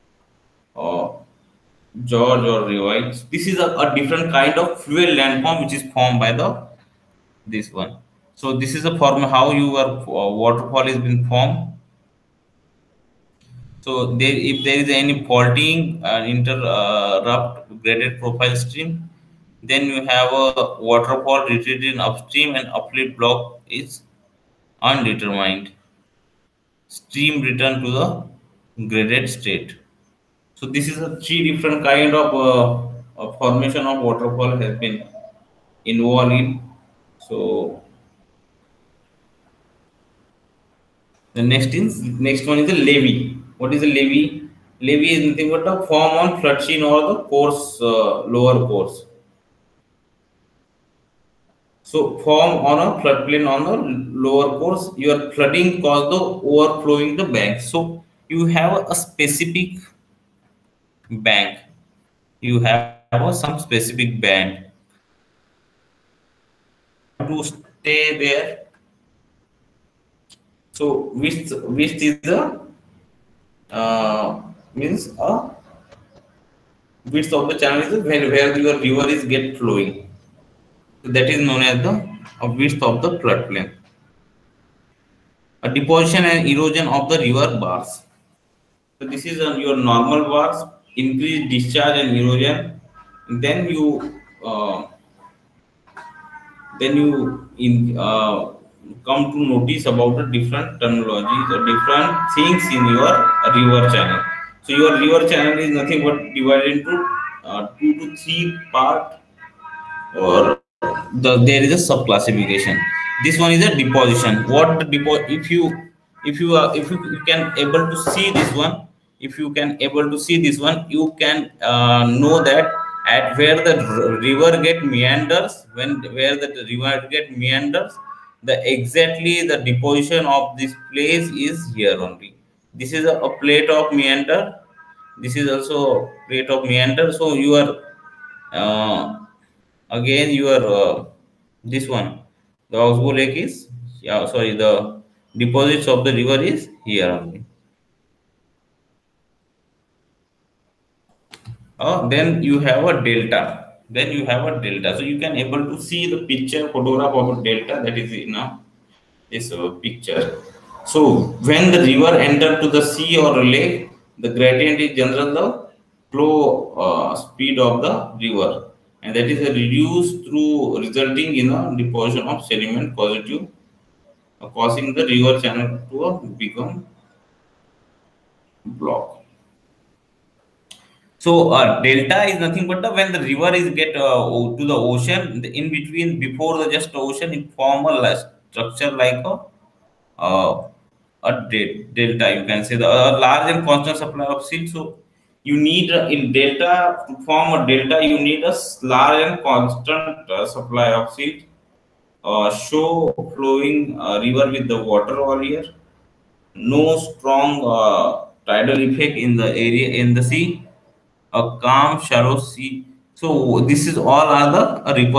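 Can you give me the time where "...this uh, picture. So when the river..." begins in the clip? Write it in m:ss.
2:39.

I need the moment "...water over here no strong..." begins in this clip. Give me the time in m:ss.
3:24.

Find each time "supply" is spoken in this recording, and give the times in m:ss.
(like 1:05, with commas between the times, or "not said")
3:14, 3:20.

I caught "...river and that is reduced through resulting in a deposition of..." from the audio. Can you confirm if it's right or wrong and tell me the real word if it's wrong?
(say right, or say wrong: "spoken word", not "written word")
right.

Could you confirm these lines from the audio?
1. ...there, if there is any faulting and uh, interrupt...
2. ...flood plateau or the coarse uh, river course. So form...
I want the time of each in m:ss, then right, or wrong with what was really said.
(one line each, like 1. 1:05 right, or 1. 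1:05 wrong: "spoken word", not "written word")
1. 0:14 right
2. 0:46 wrong: "lower", not "river".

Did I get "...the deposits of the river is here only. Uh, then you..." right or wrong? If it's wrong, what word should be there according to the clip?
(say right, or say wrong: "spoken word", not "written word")
right.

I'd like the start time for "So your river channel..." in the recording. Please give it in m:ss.
1:44.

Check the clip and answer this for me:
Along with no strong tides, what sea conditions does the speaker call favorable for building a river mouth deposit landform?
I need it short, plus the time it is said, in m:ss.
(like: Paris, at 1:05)
Calm shallow sea, at 3:31.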